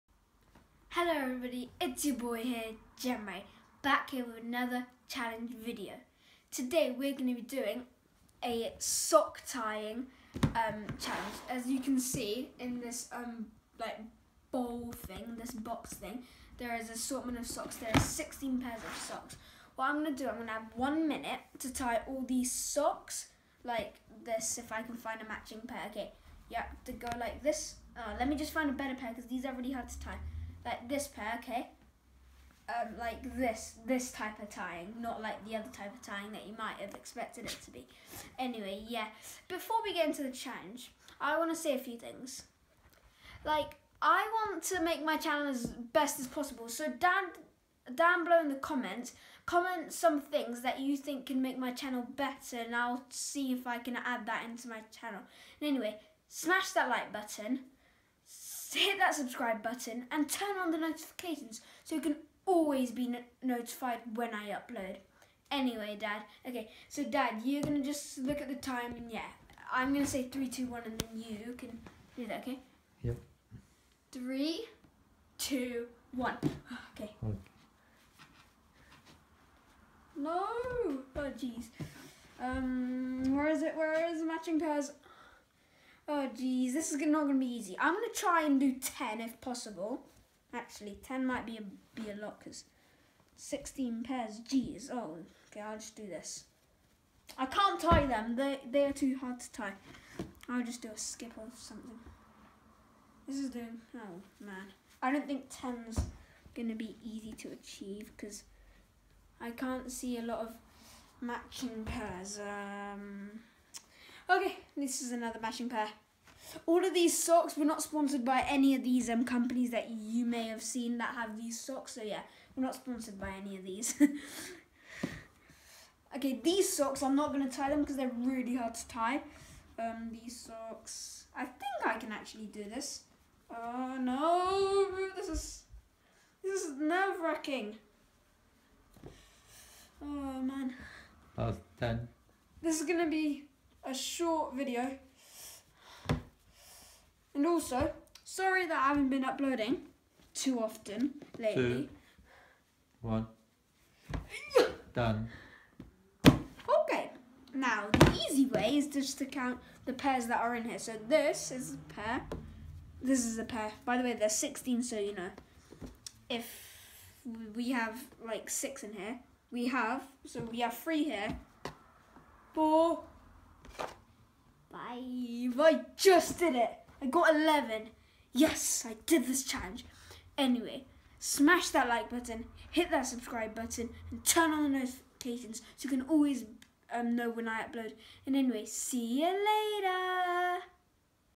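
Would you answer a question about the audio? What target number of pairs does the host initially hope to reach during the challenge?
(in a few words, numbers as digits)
10.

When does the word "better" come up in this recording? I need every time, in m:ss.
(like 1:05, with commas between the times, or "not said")
0:28, 0:52.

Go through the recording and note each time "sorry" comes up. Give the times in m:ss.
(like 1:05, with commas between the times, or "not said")
2:28.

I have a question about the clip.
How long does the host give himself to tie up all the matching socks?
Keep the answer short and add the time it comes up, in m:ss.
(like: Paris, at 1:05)
One minute, at 0:20.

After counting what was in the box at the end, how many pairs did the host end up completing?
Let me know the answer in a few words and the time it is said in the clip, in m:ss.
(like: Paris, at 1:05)
11, at 2:57.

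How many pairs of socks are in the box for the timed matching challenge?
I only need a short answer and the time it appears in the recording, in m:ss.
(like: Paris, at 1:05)
16, at 0:17.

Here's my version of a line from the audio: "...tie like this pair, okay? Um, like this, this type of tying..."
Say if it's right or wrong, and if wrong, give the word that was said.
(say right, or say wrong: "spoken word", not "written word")
right.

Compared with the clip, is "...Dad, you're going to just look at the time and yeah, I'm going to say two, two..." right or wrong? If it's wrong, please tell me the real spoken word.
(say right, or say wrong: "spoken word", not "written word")
wrong: "three", not "two".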